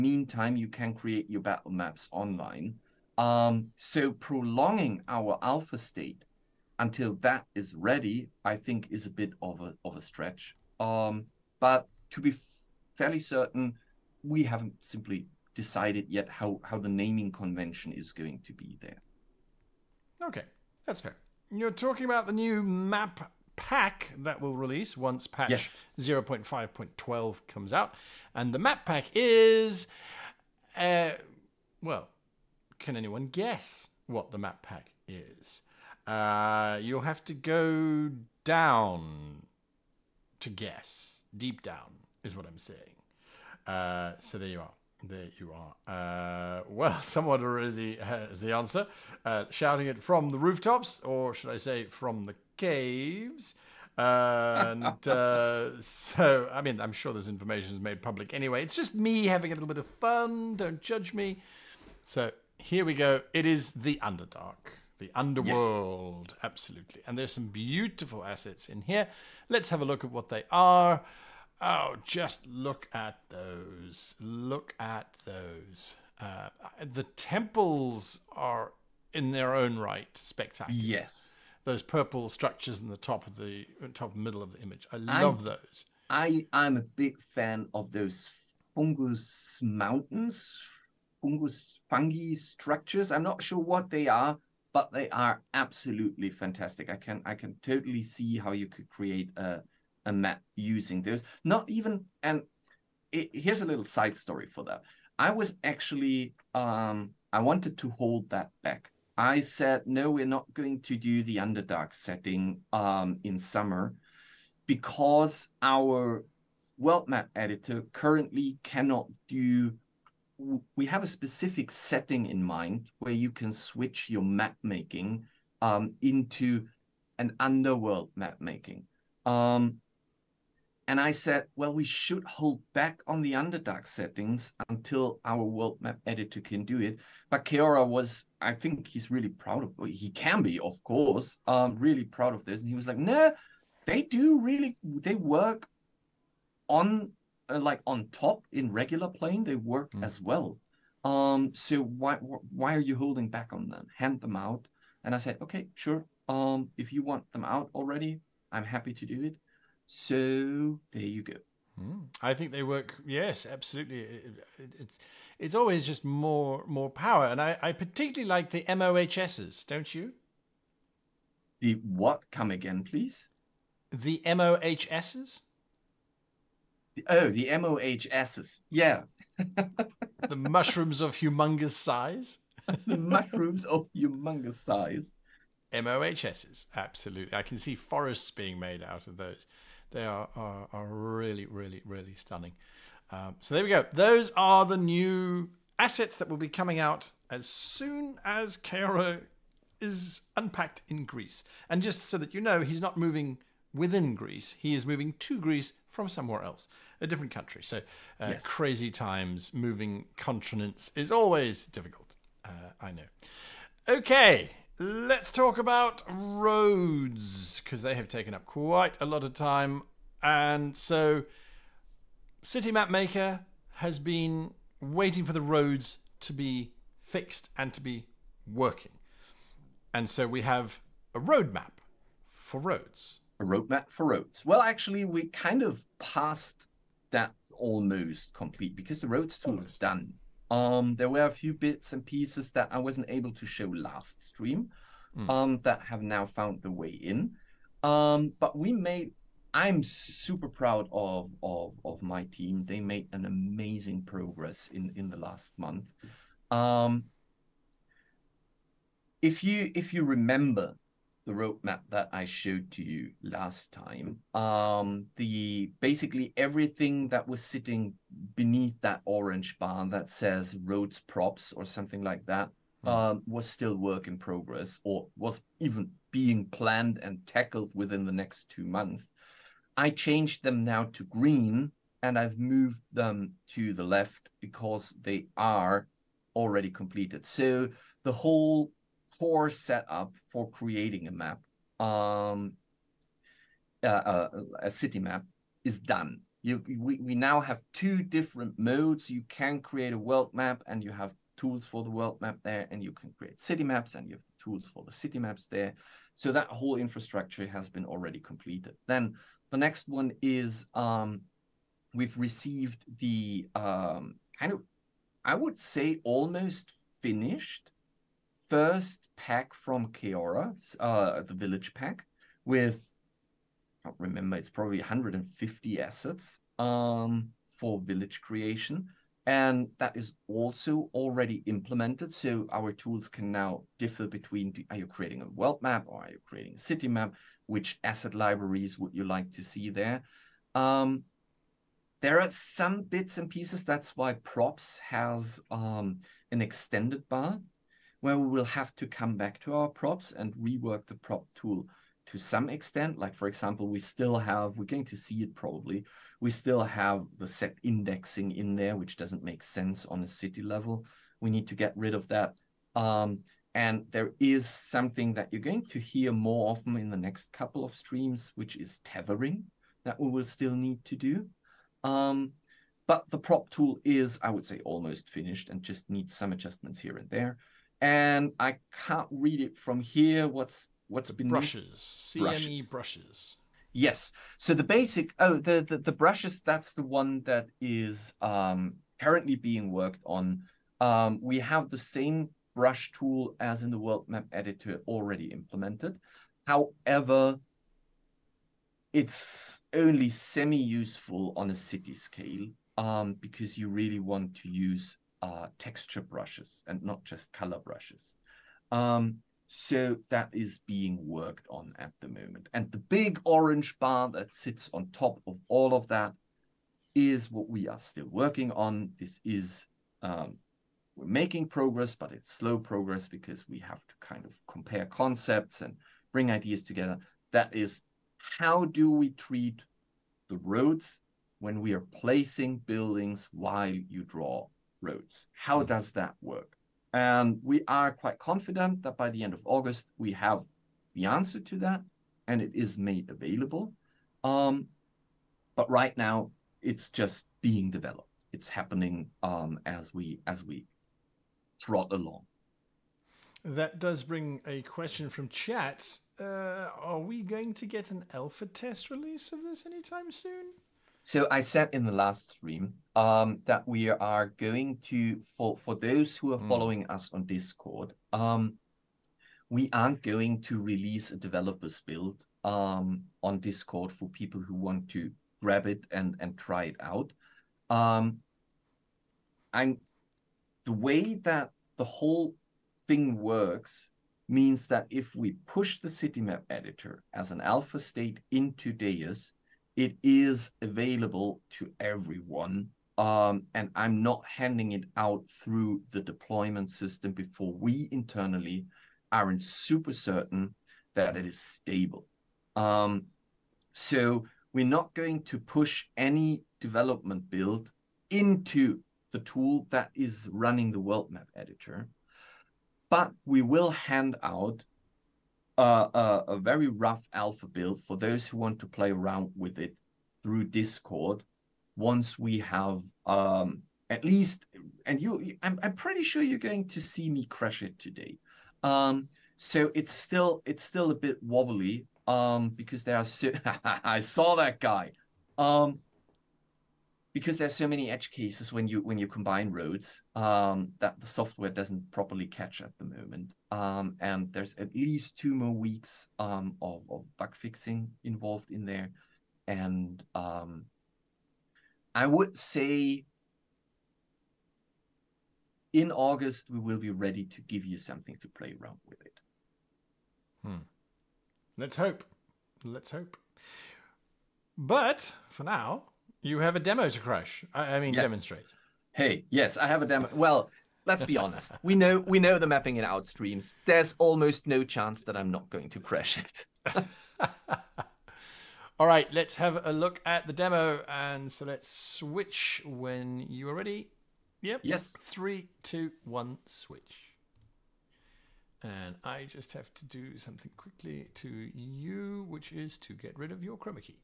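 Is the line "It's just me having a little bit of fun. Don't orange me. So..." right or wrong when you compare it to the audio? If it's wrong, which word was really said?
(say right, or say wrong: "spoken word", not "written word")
wrong: "judge", not "orange".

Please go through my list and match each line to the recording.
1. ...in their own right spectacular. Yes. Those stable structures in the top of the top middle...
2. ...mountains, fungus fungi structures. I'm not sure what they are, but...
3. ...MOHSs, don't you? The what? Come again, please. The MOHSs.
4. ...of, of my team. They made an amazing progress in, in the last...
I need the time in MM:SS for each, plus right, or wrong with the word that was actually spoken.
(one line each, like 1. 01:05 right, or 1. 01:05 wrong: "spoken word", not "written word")
1. 01:19 wrong: "purple", not "stable"
2. 01:29 right
3. 02:48 right
4. 04:11 right.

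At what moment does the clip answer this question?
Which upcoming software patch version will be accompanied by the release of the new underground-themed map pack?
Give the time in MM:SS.
00:25.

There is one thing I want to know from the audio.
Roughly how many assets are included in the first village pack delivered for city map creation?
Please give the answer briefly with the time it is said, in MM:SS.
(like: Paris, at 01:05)
150, at 05:24.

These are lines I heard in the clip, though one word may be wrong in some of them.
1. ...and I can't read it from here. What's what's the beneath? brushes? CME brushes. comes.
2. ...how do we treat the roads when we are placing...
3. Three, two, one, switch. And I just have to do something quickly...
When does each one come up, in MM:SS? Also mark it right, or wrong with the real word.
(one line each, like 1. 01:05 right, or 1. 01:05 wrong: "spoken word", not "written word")
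1. 06:17 wrong: "brushes", not "comes"
2. 07:08 right
3. 09:45 right.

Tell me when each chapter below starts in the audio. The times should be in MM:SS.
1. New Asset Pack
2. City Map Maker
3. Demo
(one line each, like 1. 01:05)
1. 00:20
2. 03:40
3. 09:25.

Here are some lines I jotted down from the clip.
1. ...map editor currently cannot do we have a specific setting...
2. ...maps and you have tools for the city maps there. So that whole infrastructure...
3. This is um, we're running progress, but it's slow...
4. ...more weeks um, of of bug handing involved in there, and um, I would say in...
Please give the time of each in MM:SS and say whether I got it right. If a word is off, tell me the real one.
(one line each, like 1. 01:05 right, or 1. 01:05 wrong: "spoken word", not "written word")
1. 01:57 right
2. 05:03 right
3. 06:58 wrong: "making", not "running"
4. 09:05 wrong: "fixing", not "handing".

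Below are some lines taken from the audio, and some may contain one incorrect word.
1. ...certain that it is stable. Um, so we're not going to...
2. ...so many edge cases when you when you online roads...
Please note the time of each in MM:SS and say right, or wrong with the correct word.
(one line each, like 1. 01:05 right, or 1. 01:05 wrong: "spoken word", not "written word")
1. 08:19 right
2. 08:57 wrong: "combine", not "online".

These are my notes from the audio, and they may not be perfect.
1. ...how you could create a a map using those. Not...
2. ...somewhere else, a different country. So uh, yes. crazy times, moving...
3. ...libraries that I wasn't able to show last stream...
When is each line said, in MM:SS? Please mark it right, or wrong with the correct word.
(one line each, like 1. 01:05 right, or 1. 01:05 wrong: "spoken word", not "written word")
1. 01:38 right
2. 03:26 right
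3. 04:02 wrong: "pieces", not "libraries".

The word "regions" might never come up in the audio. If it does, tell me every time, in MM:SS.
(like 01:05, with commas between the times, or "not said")
not said.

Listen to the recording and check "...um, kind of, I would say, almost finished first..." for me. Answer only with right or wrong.
right.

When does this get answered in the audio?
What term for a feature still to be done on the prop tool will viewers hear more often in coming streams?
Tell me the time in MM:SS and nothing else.
06:08.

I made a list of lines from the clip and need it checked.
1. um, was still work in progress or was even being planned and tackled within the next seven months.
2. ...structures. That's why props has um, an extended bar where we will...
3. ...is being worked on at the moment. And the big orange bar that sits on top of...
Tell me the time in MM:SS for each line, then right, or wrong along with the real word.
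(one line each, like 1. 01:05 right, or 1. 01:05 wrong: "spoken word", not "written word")
1. 04:32 wrong: "two", not "seven"
2. 05:43 wrong: "pieces", not "structures"
3. 06:50 right.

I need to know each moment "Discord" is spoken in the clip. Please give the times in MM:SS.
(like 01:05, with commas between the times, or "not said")
07:47, 07:53, 08:40.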